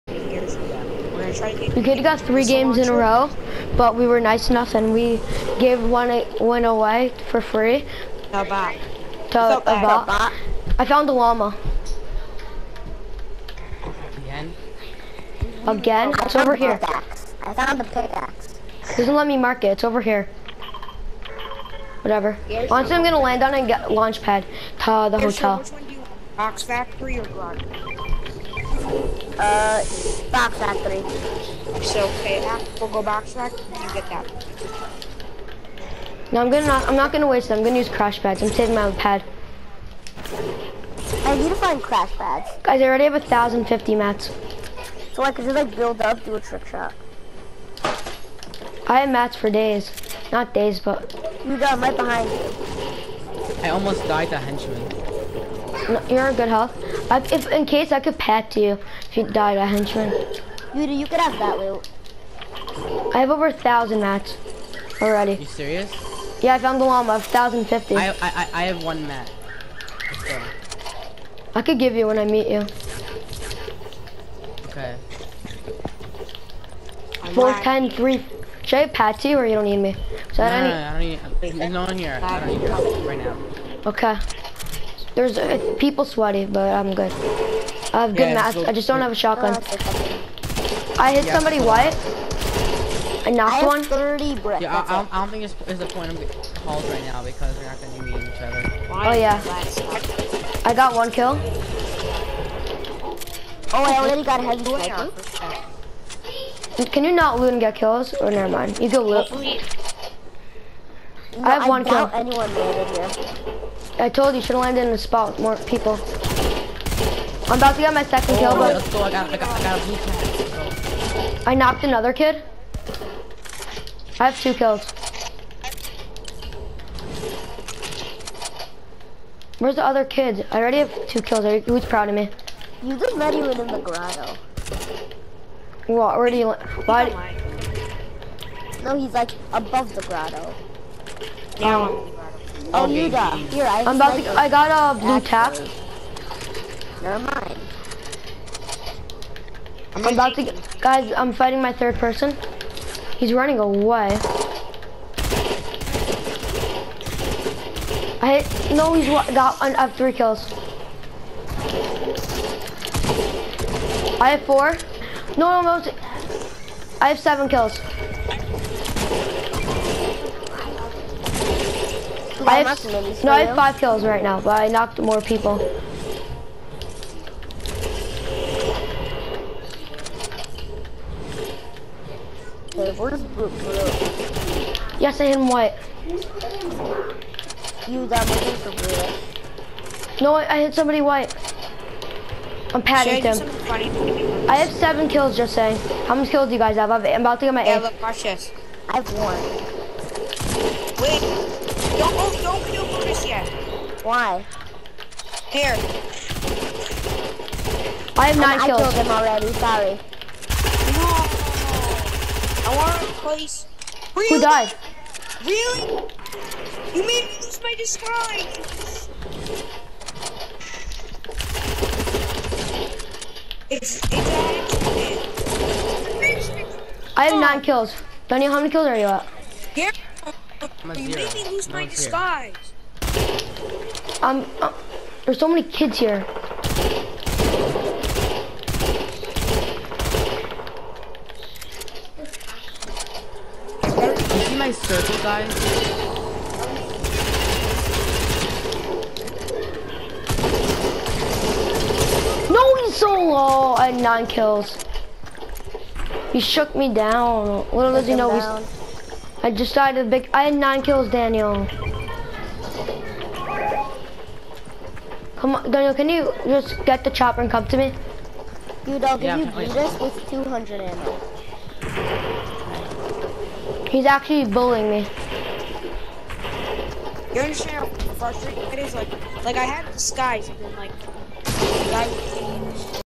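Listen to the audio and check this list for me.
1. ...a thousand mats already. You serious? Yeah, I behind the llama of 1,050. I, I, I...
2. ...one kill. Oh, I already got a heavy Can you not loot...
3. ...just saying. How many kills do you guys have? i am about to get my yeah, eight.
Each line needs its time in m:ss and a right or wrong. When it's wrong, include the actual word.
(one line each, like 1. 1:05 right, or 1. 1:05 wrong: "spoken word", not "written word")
1. 1:03 wrong: "found", not "behind"
2. 1:40 right
3. 3:15 right.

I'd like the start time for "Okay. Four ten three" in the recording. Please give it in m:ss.
1:14.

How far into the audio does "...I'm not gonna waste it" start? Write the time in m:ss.
0:36.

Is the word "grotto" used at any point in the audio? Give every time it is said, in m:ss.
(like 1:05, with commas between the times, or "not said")
2:13, 2:20.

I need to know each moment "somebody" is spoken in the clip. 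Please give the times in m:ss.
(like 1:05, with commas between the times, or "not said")
1:31, 3:10.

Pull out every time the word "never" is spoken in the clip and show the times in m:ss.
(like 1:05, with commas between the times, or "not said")
1:48, 2:27.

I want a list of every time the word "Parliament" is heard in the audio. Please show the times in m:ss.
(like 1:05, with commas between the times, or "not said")
not said.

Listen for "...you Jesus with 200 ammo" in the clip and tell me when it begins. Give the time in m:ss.
4:29.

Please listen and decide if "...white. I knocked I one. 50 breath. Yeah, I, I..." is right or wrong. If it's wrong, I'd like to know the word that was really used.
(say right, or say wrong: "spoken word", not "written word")
wrong: "30", not "50".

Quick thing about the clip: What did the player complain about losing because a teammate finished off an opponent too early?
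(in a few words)
Disguise.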